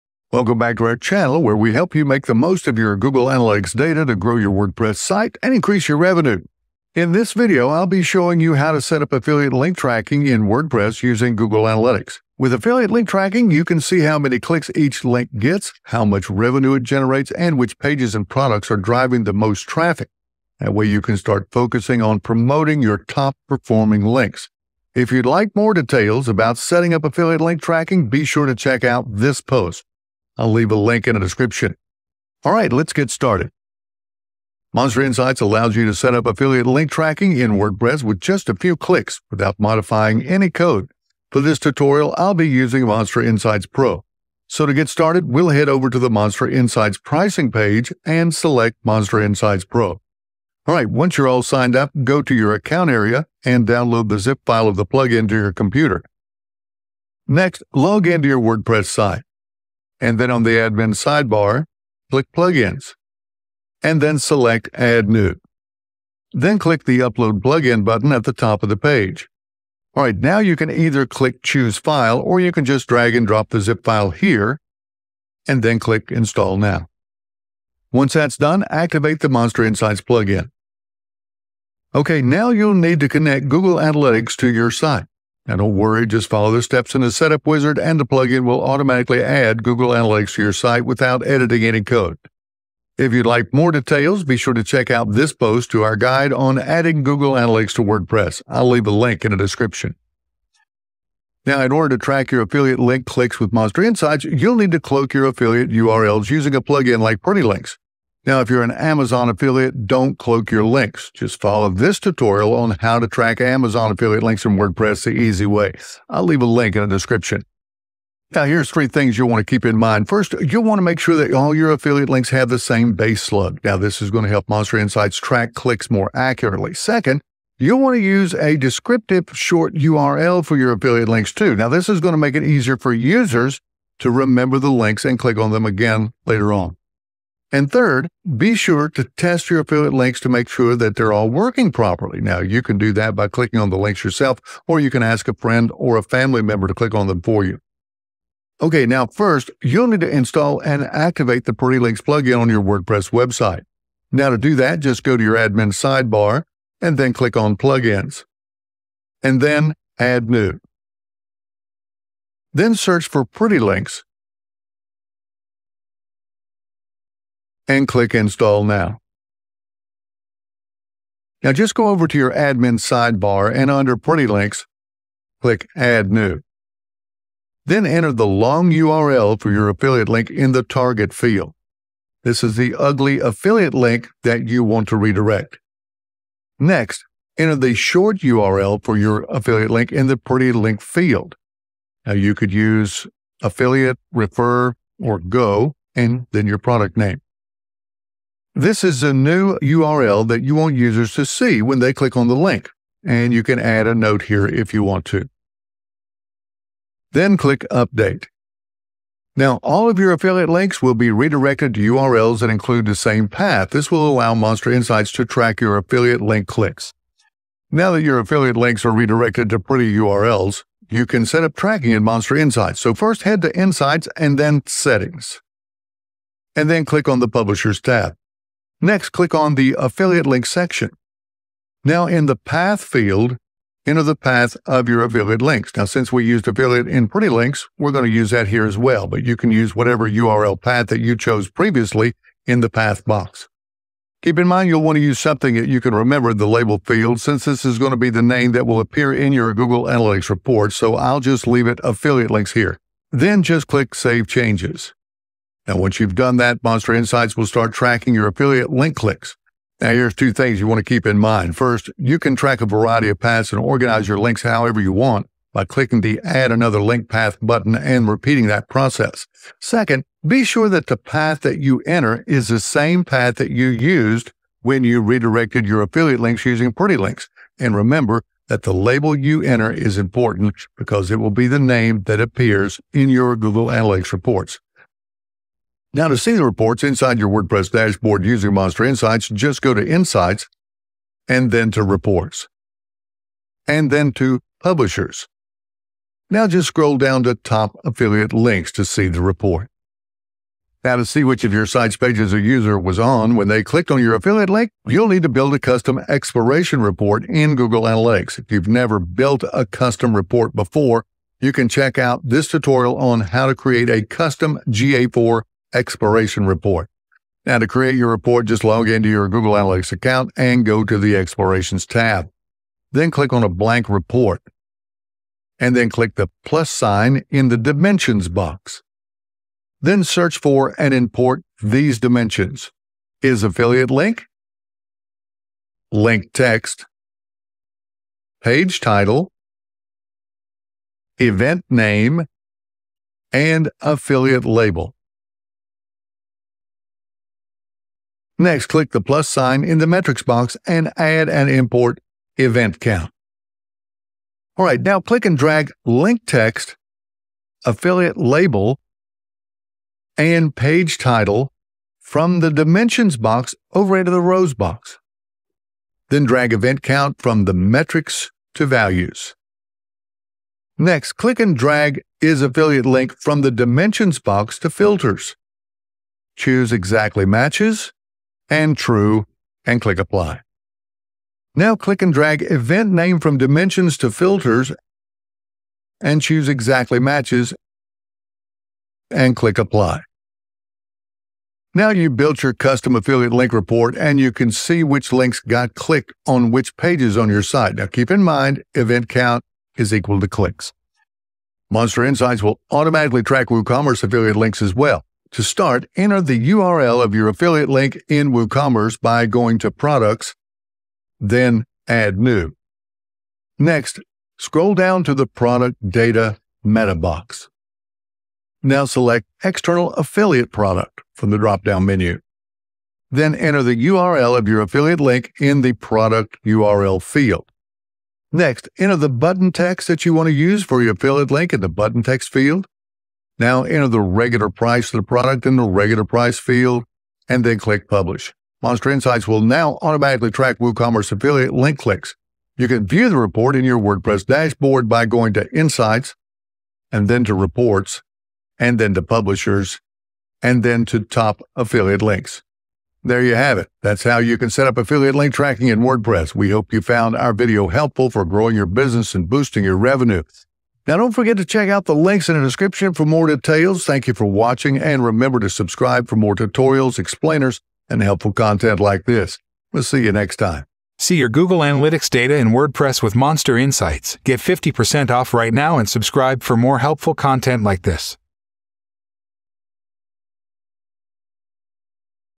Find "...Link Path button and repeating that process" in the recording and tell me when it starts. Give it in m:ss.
4:26.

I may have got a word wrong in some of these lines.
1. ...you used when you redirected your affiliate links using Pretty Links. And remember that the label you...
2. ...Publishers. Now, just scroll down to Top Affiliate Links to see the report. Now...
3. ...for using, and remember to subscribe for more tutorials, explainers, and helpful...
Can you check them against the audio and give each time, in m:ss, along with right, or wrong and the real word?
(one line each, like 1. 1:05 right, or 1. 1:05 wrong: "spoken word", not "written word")
1. 4:33 right
2. 4:54 right
3. 7:44 wrong: "watching", not "using".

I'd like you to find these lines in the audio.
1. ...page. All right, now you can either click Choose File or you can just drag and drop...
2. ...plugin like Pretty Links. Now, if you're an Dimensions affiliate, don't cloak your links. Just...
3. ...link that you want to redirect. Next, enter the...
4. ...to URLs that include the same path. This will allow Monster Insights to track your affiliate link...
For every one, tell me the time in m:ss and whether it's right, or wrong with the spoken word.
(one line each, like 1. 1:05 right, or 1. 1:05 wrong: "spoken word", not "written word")
1. 1:08 right
2. 1:46 wrong: "Amazon", not "Dimensions"
3. 3:03 right
4. 3:31 right.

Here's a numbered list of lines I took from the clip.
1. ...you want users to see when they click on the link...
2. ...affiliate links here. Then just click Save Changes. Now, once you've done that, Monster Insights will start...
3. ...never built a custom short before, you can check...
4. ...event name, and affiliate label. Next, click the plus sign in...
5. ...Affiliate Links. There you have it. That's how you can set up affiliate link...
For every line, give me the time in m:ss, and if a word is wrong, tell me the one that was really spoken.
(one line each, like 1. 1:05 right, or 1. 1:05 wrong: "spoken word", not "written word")
1. 3:20 right
2. 4:11 right
3. 5:08 wrong: "report", not "short"
4. 5:41 right
5. 7:31 right.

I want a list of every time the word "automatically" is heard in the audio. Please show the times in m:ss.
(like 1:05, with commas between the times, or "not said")
1:28, 6:42, 7:19.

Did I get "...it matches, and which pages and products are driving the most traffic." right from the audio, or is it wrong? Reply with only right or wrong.
wrong.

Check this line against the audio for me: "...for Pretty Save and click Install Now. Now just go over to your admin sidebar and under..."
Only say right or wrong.
wrong.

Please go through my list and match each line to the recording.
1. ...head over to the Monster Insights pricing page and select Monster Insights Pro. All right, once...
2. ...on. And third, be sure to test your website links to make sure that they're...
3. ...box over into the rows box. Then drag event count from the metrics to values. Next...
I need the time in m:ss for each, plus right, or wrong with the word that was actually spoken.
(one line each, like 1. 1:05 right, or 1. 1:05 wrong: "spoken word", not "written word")
1. 0:45 right
2. 2:16 wrong: "affiliate", not "website"
3. 6:03 right.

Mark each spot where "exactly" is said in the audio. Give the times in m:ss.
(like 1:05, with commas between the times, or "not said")
6:16, 6:26.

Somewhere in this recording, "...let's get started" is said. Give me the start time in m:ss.
0:32.